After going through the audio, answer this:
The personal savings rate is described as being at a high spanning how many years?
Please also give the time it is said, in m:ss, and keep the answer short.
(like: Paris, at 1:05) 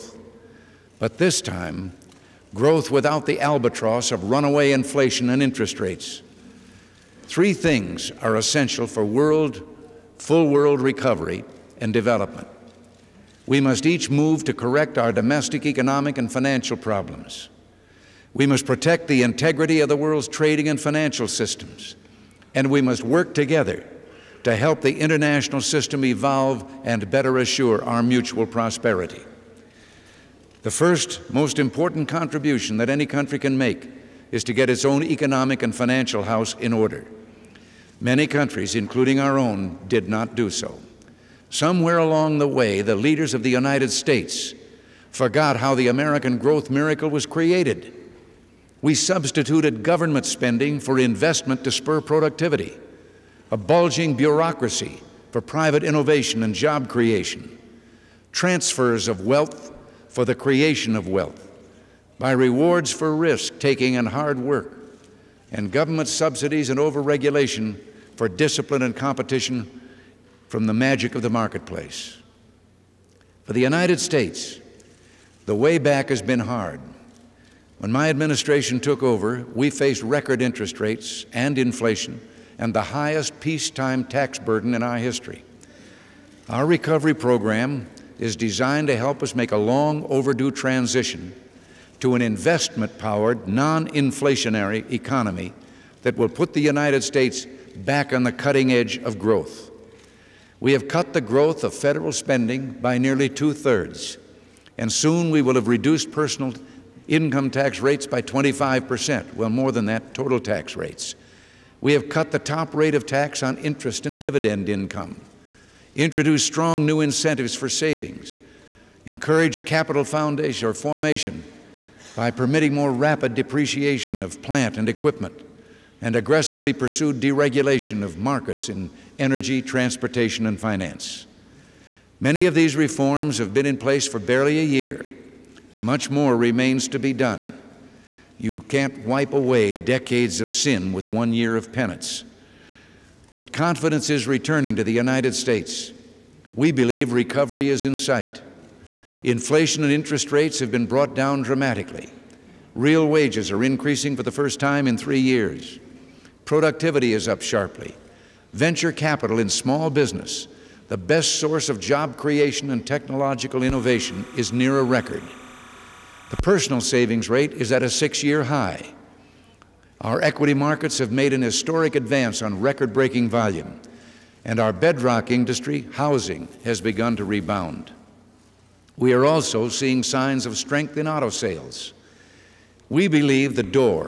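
6, at 2:47.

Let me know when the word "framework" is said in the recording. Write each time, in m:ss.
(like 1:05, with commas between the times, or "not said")
not said.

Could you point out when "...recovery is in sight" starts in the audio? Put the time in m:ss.
2:27.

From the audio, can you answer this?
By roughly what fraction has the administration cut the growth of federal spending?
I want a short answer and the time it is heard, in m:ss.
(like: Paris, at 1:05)
two thirds, at 1:43.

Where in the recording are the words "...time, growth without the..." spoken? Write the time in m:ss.
0:01.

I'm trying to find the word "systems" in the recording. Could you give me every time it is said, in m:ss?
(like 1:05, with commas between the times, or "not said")
0:21, 0:25.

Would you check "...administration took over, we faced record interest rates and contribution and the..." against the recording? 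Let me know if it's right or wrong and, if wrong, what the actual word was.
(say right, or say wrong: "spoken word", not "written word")
wrong: "inflation", not "contribution".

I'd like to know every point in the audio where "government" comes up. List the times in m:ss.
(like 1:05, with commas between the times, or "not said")
0:49, 1:05.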